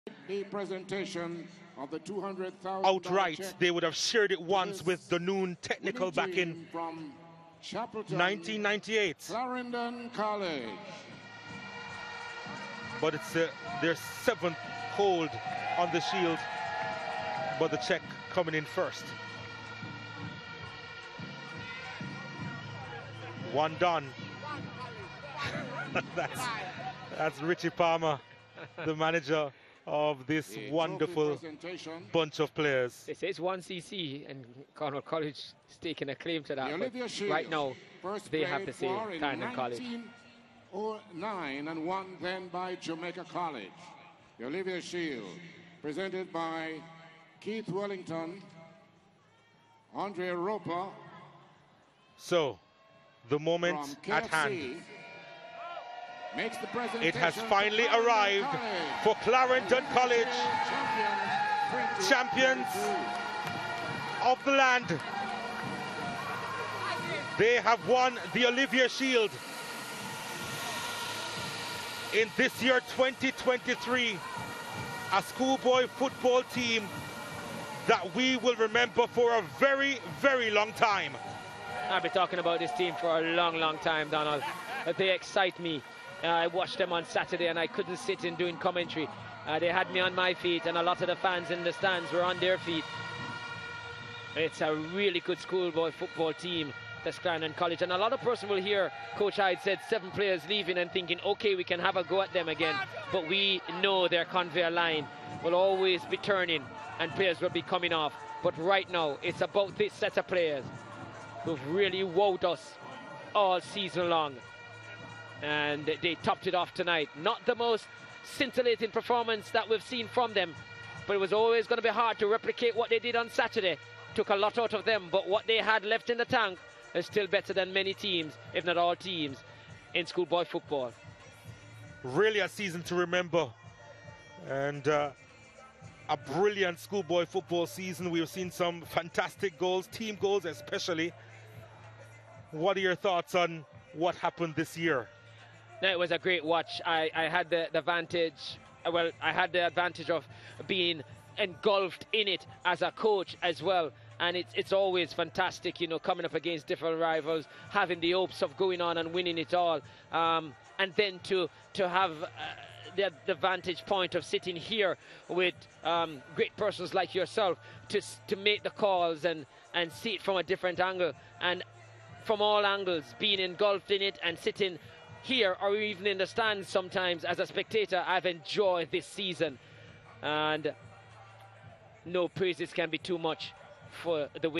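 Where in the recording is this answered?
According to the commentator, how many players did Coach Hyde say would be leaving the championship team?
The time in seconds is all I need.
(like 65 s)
99 s.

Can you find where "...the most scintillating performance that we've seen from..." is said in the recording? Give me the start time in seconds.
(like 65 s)
117 s.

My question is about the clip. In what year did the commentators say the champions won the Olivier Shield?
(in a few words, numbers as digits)
2023.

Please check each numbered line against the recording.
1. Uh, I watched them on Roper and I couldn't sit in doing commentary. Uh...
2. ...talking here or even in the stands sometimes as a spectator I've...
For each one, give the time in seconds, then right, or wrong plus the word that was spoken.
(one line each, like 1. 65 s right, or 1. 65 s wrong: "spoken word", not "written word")
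1. 86 s wrong: "Saturday", not "Roper"
2. 174 s wrong: "sitting", not "talking".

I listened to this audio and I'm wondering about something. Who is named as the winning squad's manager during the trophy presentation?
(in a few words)
Richie Palmer.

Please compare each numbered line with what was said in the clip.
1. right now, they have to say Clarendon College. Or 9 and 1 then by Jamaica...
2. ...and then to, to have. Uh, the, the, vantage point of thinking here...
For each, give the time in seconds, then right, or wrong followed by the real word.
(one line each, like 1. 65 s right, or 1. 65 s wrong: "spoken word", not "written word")
1. 37 s right
2. 160 s wrong: "sitting", not "thinking".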